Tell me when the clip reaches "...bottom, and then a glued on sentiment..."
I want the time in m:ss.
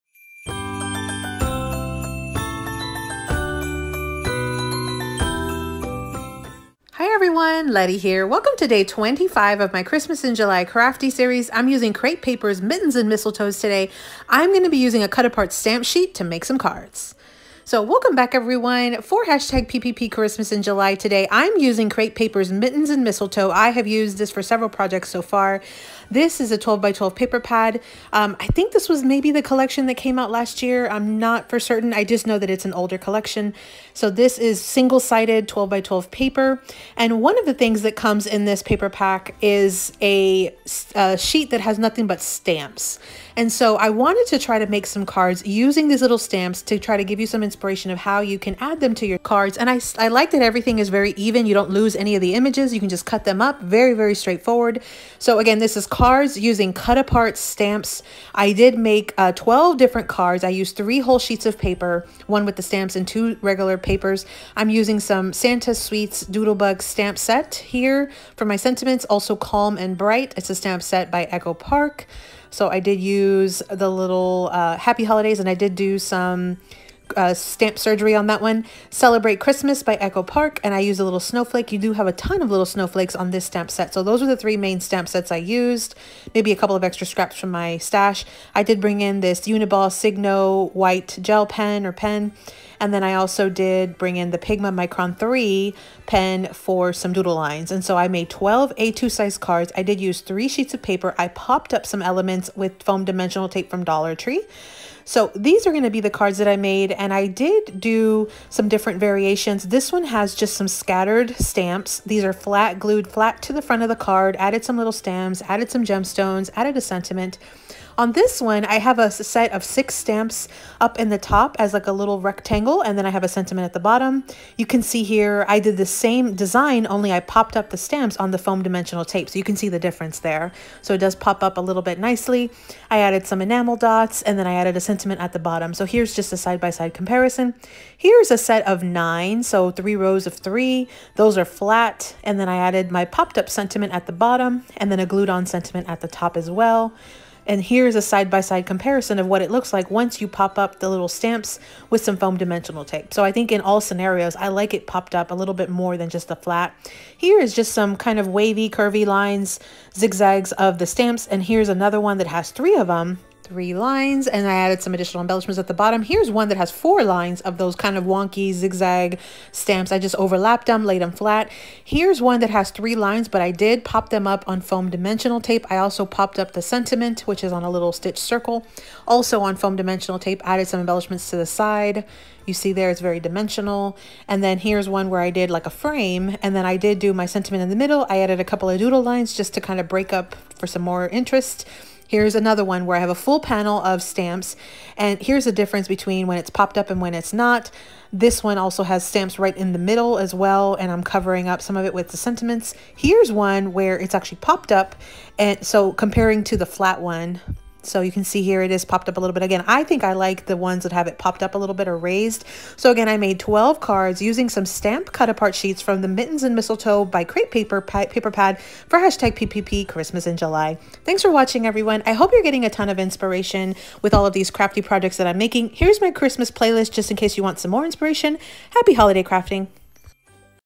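2:24.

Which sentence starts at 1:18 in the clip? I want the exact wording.
Celebrate Christmas by Echo Park, and I use a little snowflake.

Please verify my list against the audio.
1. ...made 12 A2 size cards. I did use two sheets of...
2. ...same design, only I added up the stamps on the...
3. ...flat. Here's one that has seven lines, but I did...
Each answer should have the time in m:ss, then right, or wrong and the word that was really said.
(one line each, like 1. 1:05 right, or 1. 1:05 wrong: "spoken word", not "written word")
1. 1:38 wrong: "three", not "two"
2. 2:05 wrong: "popped", not "added"
3. 2:51 wrong: "three", not "seven".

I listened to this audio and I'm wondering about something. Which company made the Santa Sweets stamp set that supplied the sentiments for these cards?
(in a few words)
Doodlebug.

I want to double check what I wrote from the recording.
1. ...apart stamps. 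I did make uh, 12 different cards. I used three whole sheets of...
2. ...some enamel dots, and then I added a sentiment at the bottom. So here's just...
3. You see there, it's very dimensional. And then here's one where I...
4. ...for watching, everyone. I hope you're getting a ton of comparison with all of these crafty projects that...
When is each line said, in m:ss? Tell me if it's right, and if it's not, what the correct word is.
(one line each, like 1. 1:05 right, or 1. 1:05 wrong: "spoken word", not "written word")
1. 0:56 right
2. 2:13 right
3. 3:02 right
4. 3:41 wrong: "inspiration", not "comparison".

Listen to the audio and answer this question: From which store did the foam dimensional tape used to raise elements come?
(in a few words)
Dollar Tree.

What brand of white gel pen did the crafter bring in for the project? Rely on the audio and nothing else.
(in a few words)
Uniball Signo.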